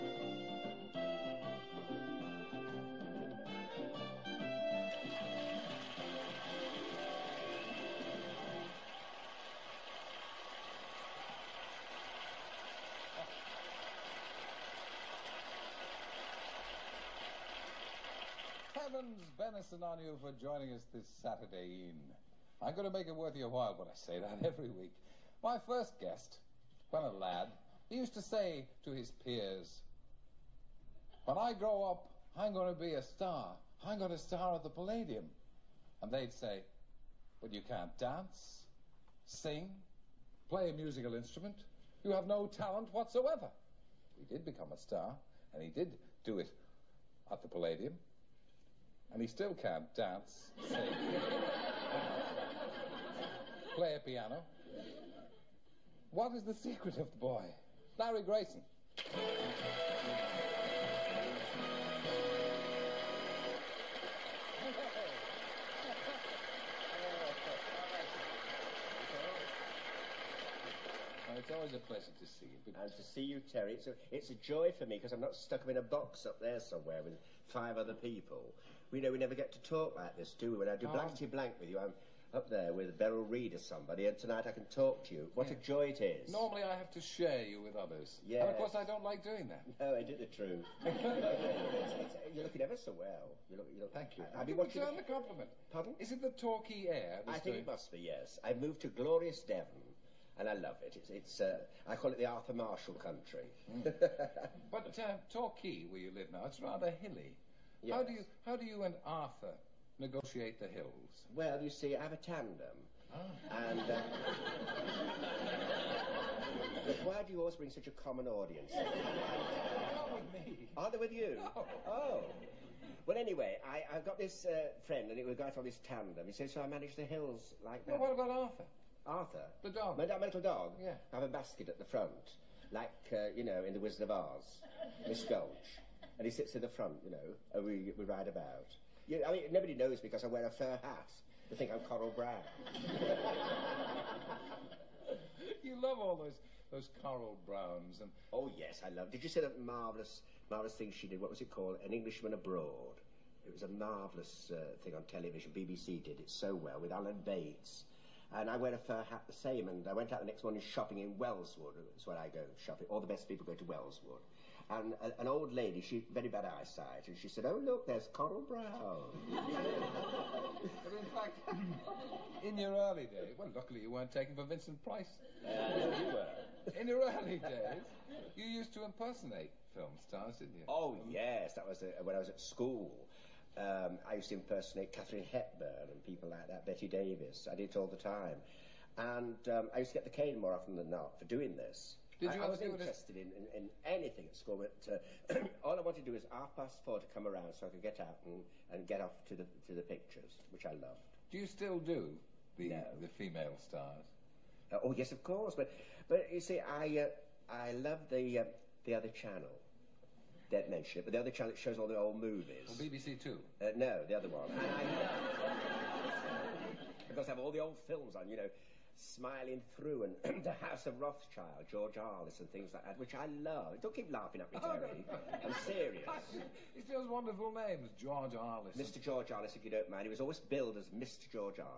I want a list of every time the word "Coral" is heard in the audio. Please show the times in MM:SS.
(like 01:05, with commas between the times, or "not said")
02:21, 02:27, 02:48.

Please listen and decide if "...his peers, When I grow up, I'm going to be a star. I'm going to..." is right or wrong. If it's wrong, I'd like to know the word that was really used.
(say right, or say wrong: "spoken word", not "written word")
right.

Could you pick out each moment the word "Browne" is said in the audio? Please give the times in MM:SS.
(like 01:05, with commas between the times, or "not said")
02:22, 02:27, 02:48.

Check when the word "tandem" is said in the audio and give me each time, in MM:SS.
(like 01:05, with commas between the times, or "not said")
01:52, 02:05.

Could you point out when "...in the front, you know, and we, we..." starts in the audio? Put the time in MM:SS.
02:16.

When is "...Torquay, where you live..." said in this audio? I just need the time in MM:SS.
01:45.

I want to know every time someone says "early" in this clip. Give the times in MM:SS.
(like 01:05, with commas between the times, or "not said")
02:52, 02:57.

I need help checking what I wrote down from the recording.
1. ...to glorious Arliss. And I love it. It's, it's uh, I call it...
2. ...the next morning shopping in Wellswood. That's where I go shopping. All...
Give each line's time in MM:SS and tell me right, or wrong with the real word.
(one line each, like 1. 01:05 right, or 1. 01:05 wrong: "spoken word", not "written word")
1. 01:38 wrong: "Devon", not "Arliss"
2. 02:40 right.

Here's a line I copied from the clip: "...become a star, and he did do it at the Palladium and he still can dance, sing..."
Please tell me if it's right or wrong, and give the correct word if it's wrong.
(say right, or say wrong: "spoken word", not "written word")
right.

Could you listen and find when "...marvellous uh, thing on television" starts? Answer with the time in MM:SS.
02:33.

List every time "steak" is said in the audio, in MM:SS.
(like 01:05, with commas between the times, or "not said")
not said.